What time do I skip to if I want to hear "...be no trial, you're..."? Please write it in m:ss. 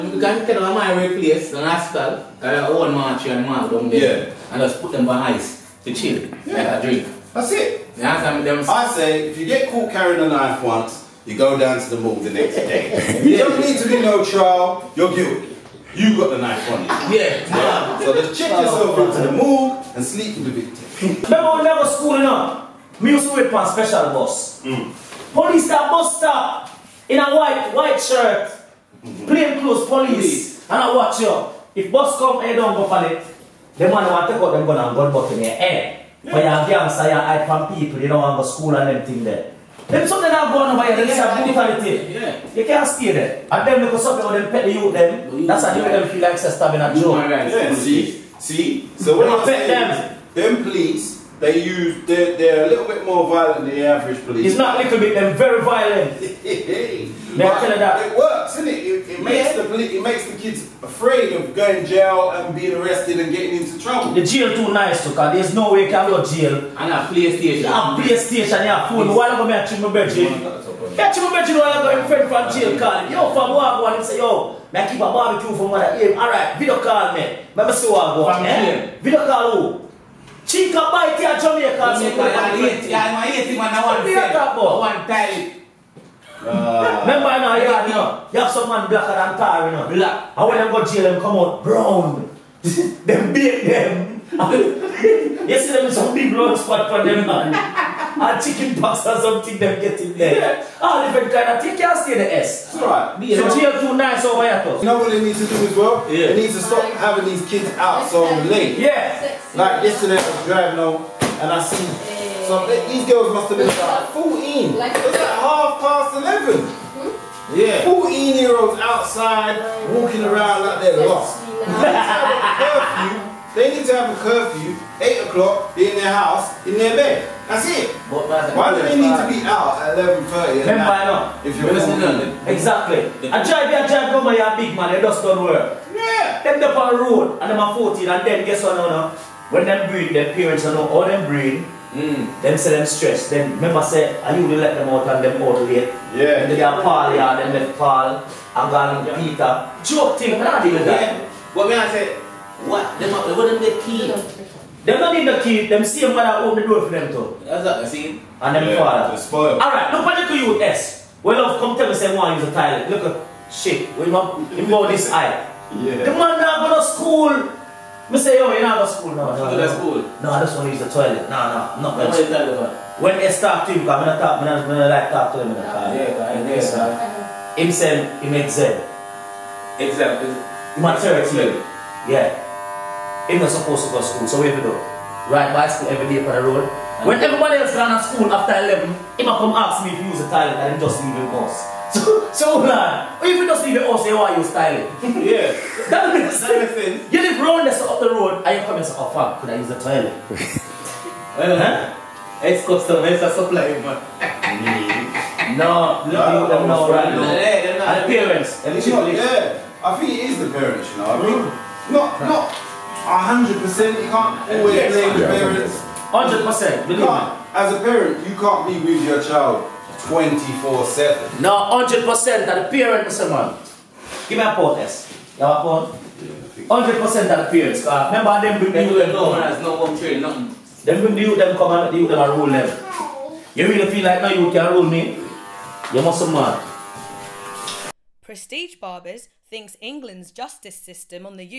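0:13.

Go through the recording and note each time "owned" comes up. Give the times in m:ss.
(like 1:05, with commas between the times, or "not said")
not said.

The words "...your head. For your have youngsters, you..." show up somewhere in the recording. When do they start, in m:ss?
0:35.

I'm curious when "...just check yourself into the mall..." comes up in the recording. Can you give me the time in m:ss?
0:18.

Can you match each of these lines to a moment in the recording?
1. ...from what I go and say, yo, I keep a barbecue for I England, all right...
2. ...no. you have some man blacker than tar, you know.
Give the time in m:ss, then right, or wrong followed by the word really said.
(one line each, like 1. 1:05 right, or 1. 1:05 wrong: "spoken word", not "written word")
1. 1:13 wrong: "Hey", not "England"
2. 1:27 right.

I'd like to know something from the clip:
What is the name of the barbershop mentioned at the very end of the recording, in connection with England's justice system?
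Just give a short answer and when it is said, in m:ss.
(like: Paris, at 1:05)
Prestige Barbers, at 3:58.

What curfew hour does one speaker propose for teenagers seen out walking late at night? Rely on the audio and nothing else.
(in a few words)
8 o'clock.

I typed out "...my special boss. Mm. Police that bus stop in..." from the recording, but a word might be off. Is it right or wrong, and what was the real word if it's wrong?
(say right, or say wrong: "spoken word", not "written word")
right.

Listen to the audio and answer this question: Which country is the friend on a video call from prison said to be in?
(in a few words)
Jamaica.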